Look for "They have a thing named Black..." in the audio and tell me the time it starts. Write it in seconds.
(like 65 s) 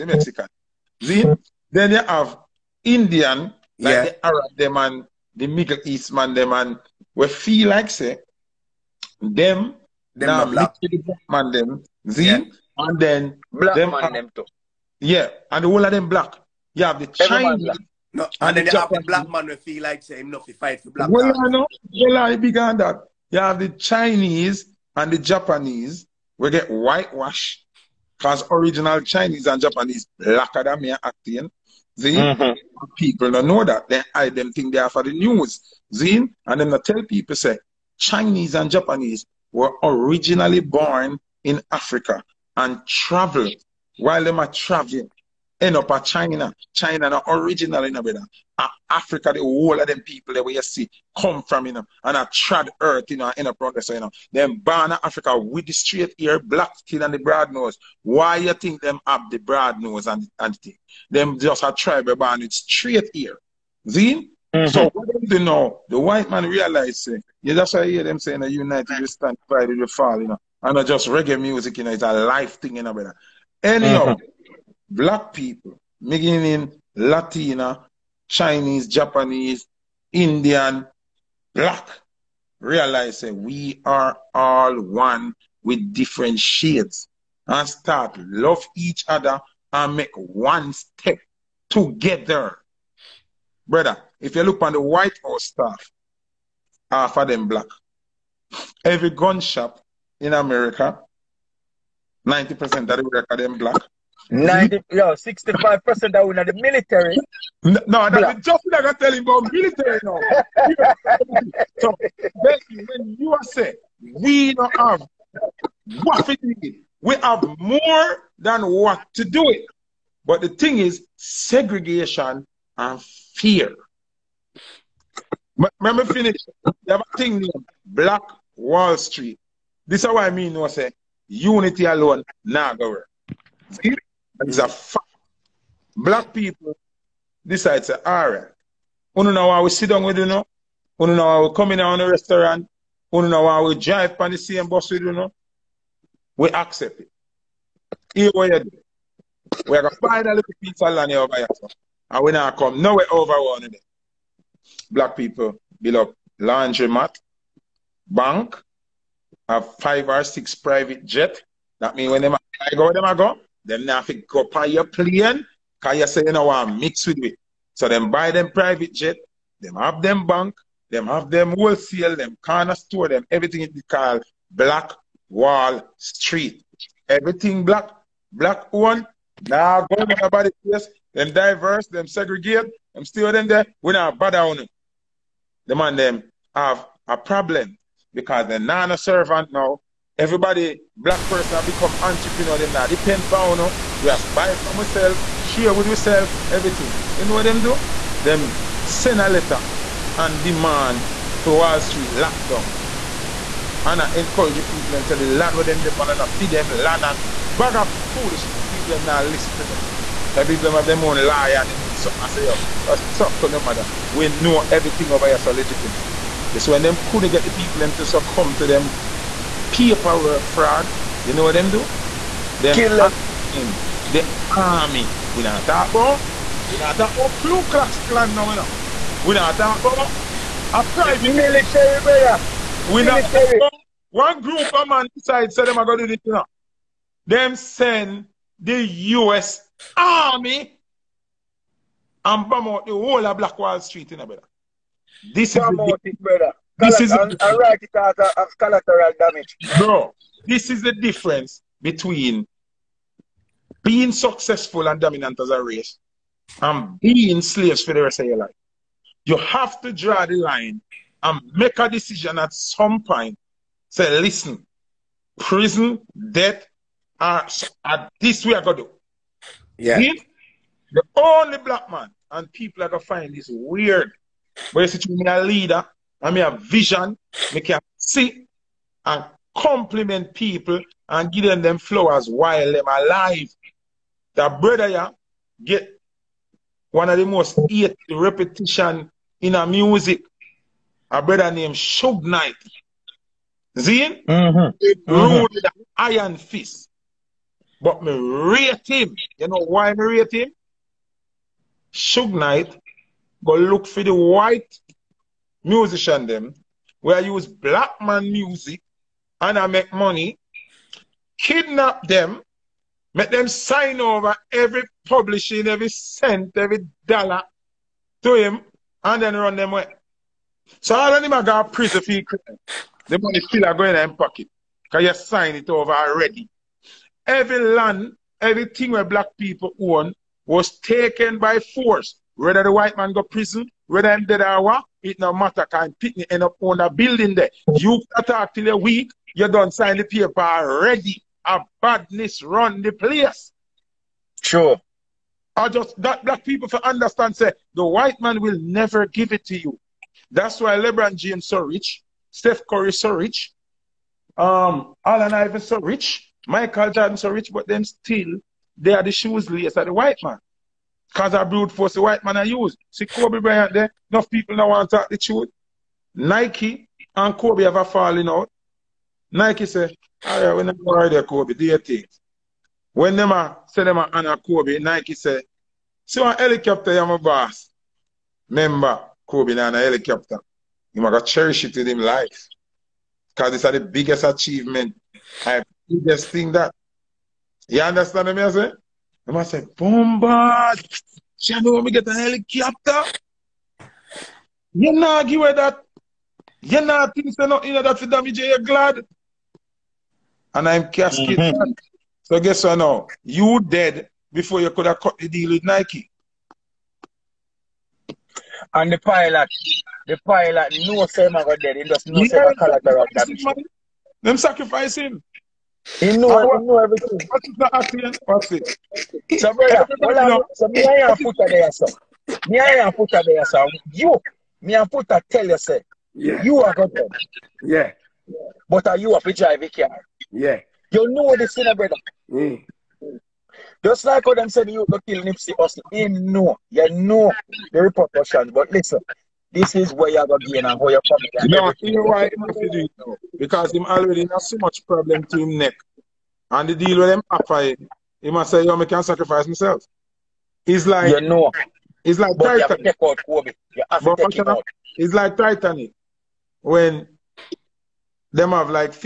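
126 s.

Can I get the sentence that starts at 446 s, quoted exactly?
And the deal with him offer him, he must say, yo, I can sacrifice myself.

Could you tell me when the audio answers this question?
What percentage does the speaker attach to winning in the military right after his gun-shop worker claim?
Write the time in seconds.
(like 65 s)
105 s.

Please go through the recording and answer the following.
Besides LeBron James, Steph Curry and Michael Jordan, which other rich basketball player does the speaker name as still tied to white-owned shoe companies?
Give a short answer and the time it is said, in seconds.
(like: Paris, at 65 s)
Allen Iverson, at 355 s.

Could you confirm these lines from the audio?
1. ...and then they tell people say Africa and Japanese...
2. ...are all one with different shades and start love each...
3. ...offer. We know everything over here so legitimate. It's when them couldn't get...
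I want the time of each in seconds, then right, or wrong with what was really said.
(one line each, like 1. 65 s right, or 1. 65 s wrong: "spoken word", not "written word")
1. 36 s wrong: "Chinese", not "Africa"
2. 83 s right
3. 213 s wrong: "matter", not "offer".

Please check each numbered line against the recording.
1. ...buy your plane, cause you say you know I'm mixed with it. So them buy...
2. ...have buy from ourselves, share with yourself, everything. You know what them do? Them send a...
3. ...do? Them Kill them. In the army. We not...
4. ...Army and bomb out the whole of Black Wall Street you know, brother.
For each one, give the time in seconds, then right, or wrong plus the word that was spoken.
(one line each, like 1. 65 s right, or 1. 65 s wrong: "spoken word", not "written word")
1. 164 s right
2. 194 s right
3. 221 s right
4. 239 s right.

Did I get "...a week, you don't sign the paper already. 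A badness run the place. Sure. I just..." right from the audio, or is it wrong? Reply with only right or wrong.
right.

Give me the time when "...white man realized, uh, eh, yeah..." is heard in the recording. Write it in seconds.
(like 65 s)
66 s.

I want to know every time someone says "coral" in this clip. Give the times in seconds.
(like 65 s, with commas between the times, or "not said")
not said.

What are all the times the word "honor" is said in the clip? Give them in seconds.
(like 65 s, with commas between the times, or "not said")
not said.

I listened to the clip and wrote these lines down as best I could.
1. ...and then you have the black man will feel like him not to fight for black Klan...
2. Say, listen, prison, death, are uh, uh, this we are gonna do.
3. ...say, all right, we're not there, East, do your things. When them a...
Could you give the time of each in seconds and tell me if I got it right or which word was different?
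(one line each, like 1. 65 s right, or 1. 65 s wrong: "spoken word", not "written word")
1. 18 s wrong: "Well", not "Klan"
2. 263 s right
3. 369 s wrong: "Kobe", not "East".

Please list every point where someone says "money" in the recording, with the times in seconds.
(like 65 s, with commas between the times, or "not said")
309 s, 323 s.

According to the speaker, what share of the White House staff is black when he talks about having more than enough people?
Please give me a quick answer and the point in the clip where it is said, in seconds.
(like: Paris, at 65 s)
half, at 96 s.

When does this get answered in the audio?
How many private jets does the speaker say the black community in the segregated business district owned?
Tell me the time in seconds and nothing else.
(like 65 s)
159 s.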